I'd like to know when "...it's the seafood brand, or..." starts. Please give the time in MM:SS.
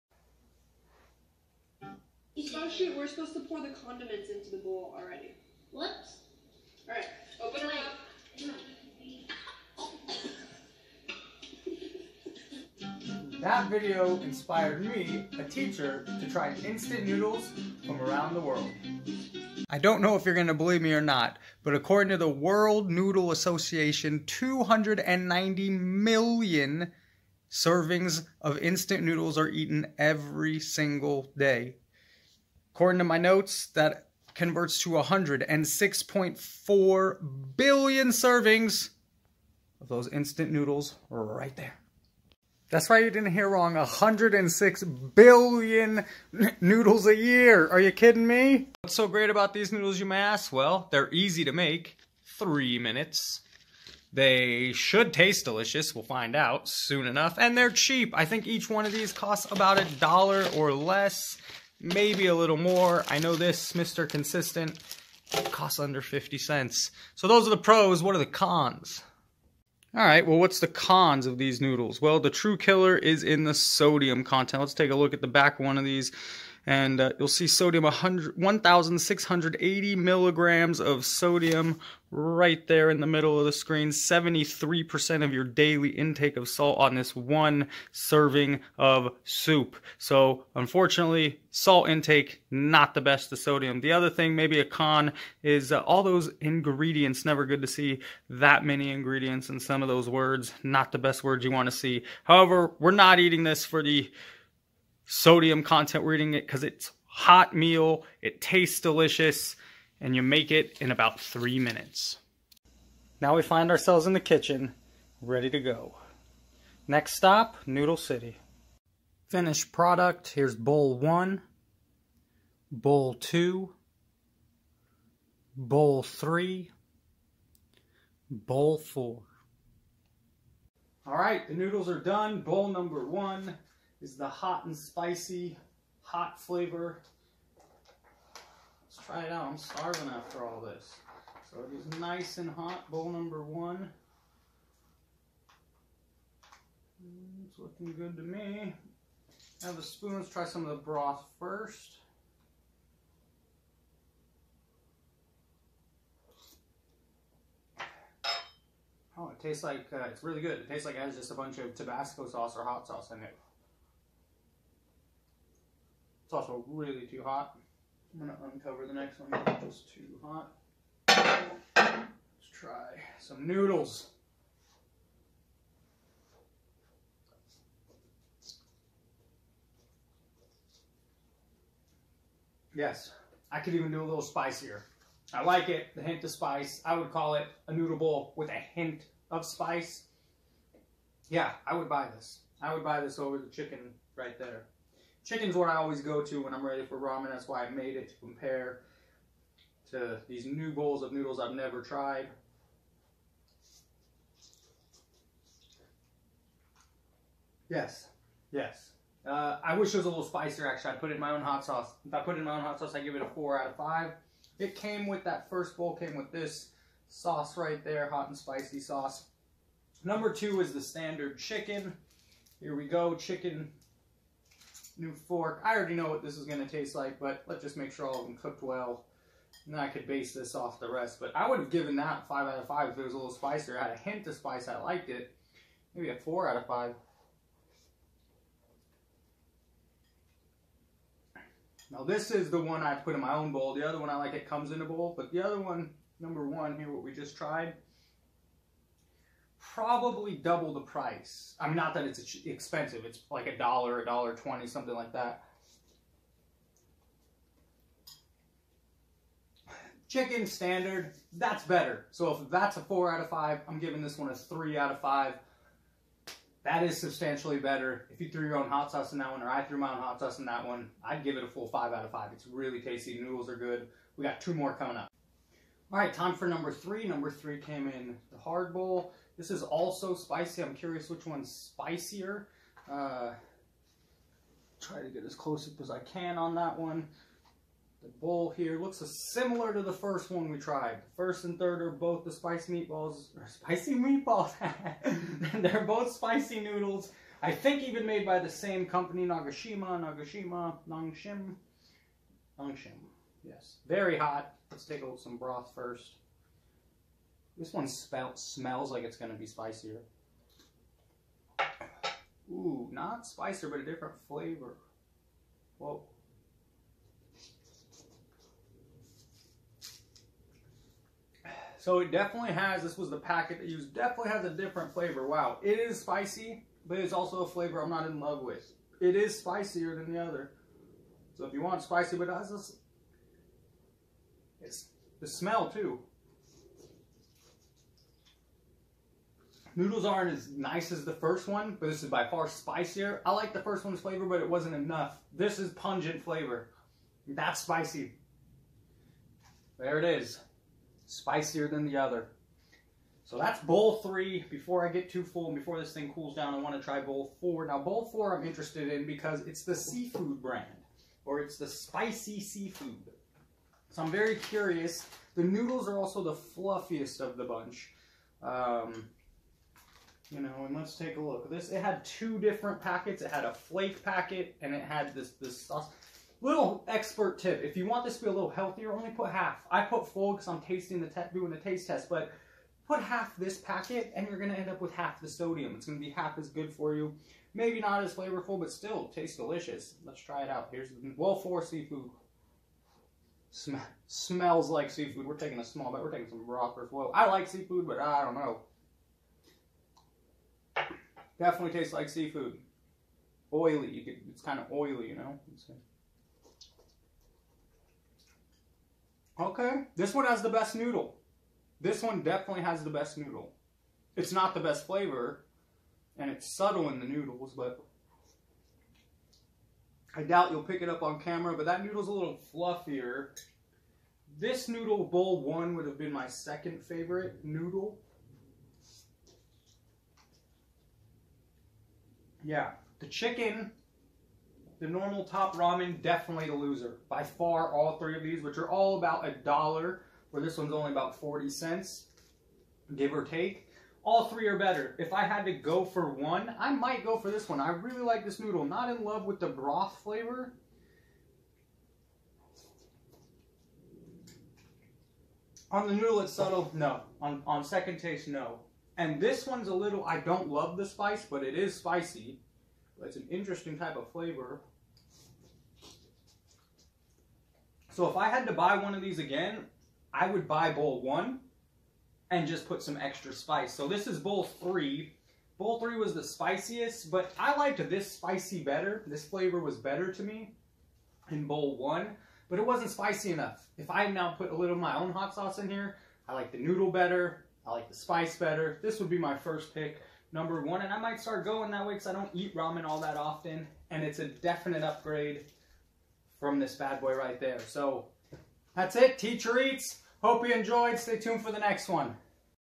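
05:59.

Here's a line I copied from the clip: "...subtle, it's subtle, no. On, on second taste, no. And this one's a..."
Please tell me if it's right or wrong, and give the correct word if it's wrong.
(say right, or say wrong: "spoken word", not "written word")
wrong: "noodle", not "subtle".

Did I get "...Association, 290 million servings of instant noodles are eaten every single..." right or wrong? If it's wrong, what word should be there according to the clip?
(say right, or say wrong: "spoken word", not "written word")
right.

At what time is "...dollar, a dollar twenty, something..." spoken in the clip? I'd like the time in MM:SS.
04:13.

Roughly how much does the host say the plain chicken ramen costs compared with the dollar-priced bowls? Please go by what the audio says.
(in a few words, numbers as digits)
40 cents.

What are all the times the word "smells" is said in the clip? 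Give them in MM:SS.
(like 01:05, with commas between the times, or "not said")
05:08, 05:35, 06:34.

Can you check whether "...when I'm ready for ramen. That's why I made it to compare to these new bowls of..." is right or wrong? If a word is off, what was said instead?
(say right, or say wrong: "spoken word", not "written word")
right.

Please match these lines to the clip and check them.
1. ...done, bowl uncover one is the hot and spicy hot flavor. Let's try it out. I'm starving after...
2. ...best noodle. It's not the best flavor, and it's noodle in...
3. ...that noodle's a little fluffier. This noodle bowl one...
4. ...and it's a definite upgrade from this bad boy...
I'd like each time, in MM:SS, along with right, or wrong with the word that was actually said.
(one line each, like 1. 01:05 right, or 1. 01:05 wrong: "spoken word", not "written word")
1. 02:11 wrong: "number", not "uncover"
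2. 06:52 wrong: "subtle", not "noodle"
3. 07:01 right
4. 08:13 right.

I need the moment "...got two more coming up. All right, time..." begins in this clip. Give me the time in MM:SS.
04:34.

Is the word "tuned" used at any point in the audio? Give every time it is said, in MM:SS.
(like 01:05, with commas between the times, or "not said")
08:21.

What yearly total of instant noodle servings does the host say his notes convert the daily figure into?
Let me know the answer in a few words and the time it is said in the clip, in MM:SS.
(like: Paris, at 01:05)
106.4 billion, at 00:34.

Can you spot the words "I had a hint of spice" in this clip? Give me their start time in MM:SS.
03:53.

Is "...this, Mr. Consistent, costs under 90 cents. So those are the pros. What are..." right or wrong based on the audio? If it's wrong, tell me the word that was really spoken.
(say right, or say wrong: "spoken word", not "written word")
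wrong: "50", not "90".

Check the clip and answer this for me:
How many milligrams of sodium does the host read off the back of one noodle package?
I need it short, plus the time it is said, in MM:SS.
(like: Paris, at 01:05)
1,680, at 01:17.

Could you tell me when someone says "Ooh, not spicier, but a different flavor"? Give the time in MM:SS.
05:12.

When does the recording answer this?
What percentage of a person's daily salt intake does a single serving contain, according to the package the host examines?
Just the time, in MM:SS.
01:23.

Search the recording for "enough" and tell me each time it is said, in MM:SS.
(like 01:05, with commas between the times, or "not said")
00:57, 05:44, 08:03.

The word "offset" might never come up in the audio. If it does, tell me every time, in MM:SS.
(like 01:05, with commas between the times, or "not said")
not said.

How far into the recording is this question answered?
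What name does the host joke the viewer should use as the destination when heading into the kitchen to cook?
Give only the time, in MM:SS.
01:57.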